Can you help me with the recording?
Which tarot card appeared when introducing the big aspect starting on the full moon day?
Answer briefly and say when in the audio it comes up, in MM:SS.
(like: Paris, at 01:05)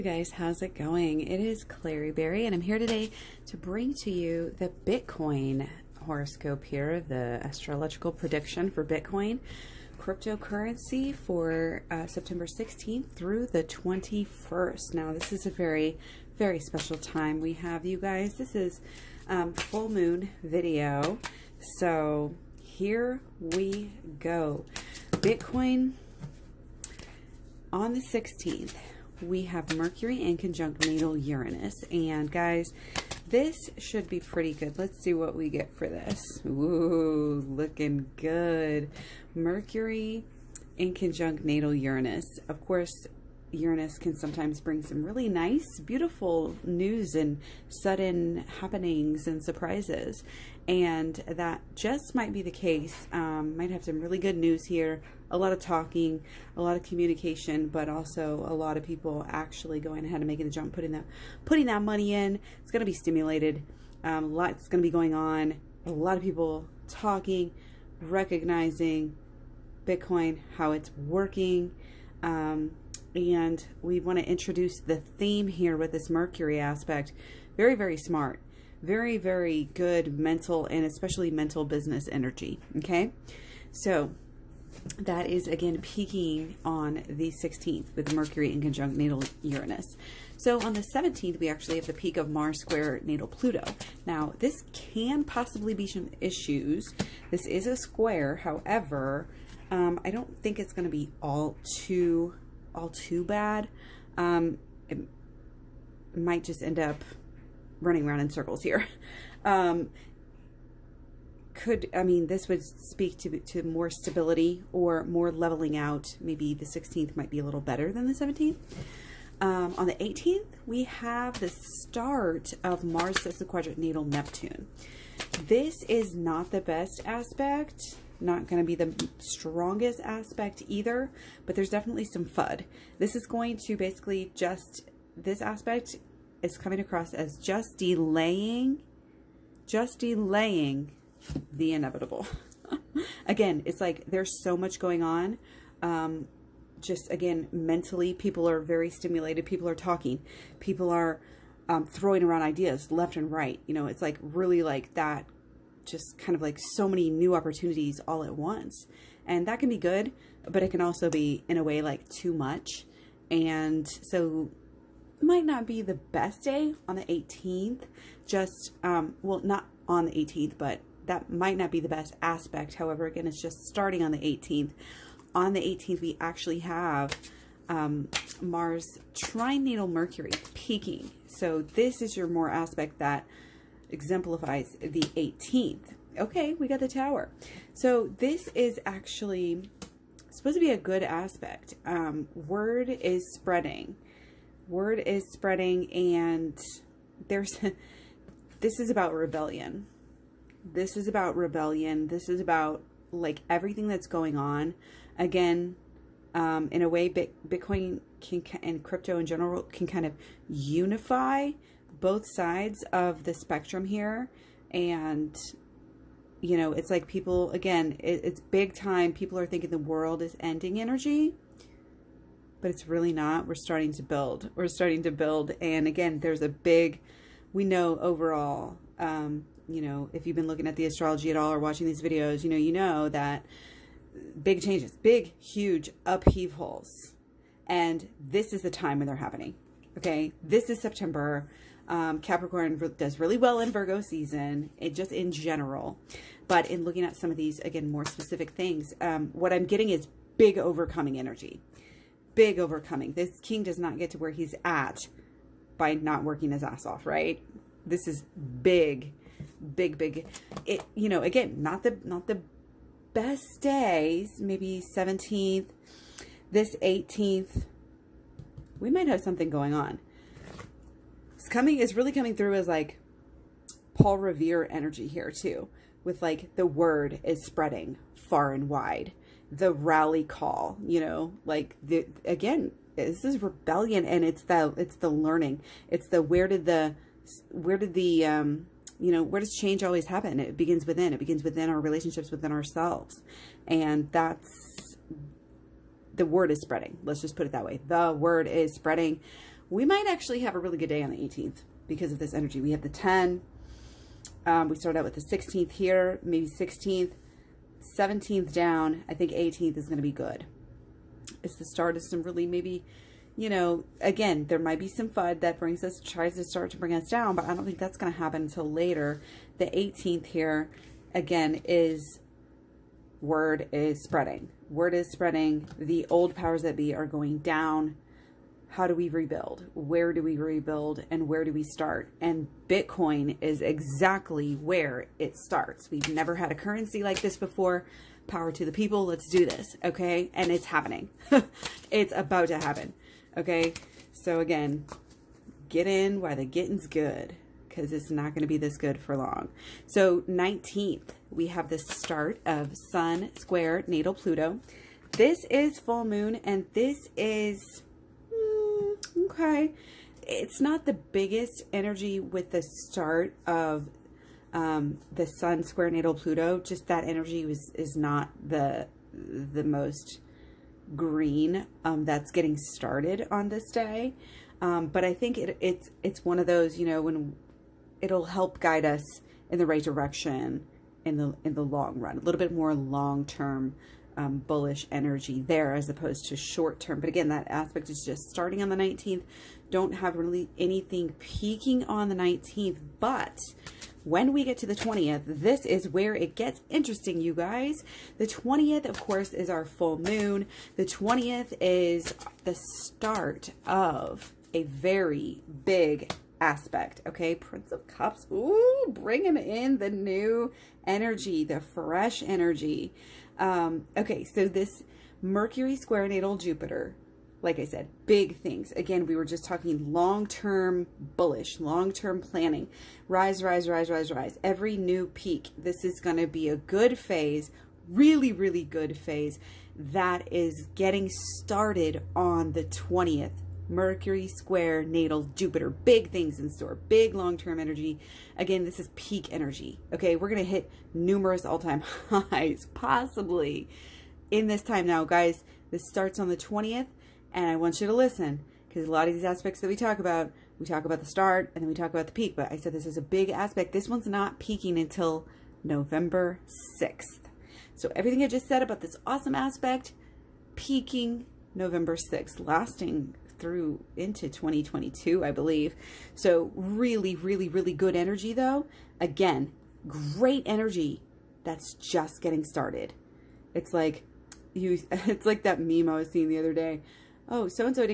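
Prince of Cups, at 06:47.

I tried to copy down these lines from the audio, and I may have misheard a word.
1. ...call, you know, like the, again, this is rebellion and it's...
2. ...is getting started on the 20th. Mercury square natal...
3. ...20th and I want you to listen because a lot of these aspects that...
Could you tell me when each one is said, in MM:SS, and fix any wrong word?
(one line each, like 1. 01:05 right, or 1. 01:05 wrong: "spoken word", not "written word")
1. 04:40 right
2. 07:10 right
3. 07:26 right.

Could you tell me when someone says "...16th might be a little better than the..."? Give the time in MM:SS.
01:56.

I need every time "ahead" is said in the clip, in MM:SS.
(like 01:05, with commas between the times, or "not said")
01:00.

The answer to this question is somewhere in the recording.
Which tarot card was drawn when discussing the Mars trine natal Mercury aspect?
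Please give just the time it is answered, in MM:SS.
03:06.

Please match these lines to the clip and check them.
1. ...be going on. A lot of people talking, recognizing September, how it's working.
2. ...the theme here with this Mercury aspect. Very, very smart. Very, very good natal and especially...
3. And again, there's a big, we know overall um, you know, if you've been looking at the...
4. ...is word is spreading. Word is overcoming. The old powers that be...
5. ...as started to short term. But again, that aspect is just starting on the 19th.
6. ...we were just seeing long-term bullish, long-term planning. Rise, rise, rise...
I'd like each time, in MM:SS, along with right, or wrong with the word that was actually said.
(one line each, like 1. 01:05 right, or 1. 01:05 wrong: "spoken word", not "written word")
1. 01:04 wrong: "Bitcoin", not "September"
2. 01:14 wrong: "mental", not "natal"
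3. 03:45 right
4. 05:21 wrong: "spreading", not "overcoming"
5. 06:25 wrong: "opposed", not "started"
6. 06:59 wrong: "talking", not "seeing".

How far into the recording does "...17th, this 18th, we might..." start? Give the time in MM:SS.
04:24.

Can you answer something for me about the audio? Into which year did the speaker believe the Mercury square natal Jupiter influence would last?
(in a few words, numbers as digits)
2022.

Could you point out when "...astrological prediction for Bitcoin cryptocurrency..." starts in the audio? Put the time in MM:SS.
00:07.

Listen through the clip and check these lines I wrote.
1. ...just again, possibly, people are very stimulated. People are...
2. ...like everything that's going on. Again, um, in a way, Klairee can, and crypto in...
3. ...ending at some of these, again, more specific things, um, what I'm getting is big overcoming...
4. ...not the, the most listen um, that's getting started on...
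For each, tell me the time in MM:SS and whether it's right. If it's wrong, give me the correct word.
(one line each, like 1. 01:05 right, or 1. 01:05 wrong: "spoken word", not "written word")
1. 02:26 wrong: "mentally", not "possibly"
2. 03:23 wrong: "Bitcoin", not "Klairee"
3. 04:06 wrong: "looking", not "ending"
4. 06:07 wrong: "green", not "listen".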